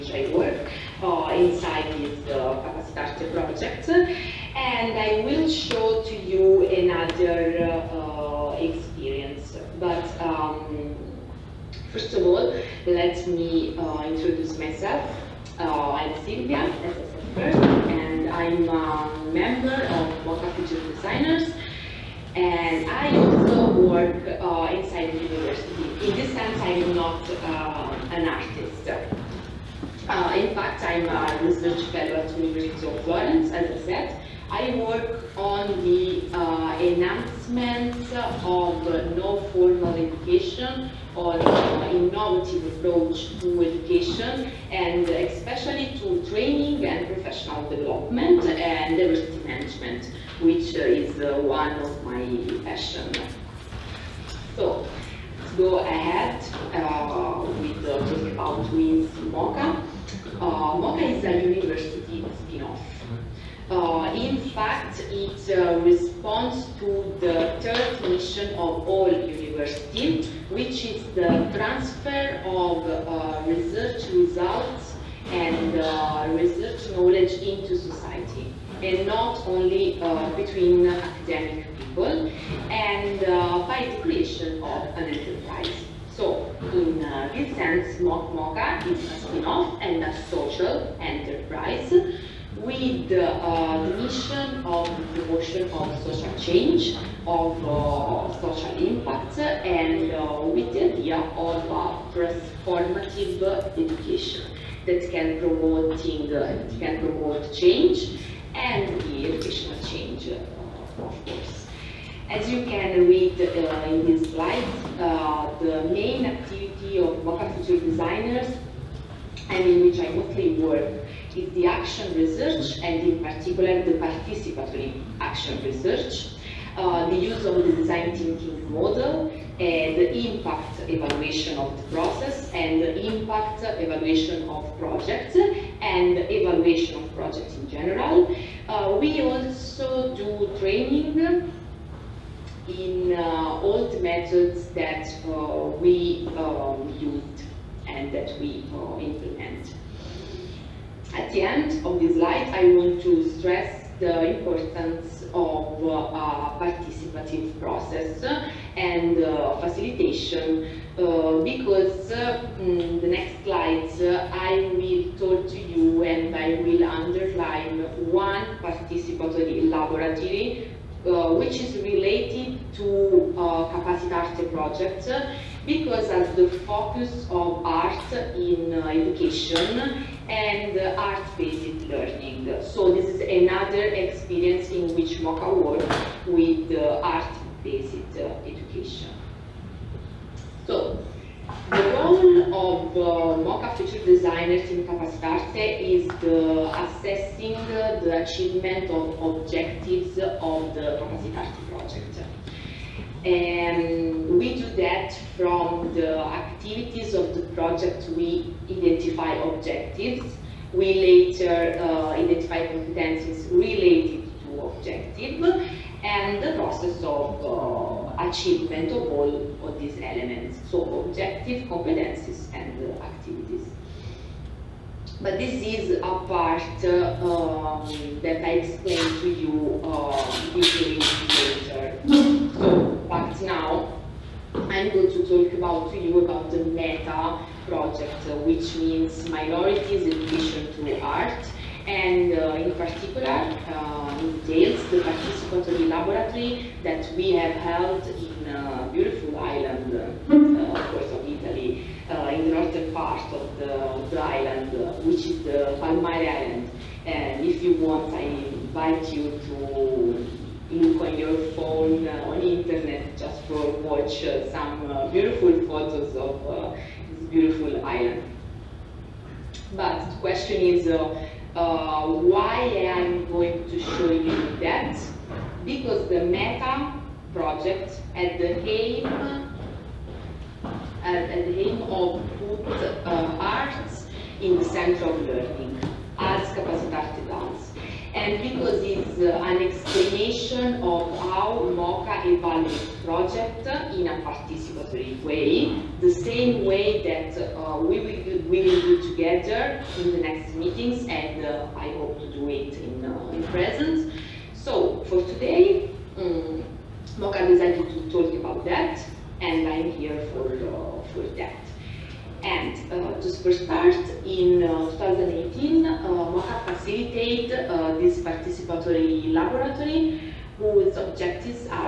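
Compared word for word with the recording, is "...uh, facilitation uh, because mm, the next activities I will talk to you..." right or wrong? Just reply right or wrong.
wrong.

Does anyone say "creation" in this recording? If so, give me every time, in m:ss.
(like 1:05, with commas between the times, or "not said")
1:24.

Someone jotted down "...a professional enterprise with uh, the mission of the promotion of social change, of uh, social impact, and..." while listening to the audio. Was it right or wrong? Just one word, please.
wrong.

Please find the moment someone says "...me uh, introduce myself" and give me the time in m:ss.
0:13.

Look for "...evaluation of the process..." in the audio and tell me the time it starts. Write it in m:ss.
2:10.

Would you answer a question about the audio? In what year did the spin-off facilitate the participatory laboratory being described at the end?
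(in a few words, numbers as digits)
2018.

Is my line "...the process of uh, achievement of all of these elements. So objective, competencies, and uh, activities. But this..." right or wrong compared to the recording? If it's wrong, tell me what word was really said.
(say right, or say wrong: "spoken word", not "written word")
right.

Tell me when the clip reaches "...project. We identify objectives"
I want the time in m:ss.
3:27.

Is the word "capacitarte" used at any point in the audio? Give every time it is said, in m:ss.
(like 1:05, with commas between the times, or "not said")
2:53, 3:14, 3:21, 4:46.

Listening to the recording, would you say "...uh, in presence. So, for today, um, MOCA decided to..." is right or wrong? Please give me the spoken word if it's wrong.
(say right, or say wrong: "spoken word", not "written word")
right.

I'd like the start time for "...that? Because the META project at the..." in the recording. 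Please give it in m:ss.
4:34.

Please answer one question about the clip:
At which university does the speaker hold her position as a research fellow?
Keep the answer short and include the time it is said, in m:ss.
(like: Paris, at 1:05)
University of Florence, at 0:32.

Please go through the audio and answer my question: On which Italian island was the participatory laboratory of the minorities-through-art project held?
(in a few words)
Palmaria Island.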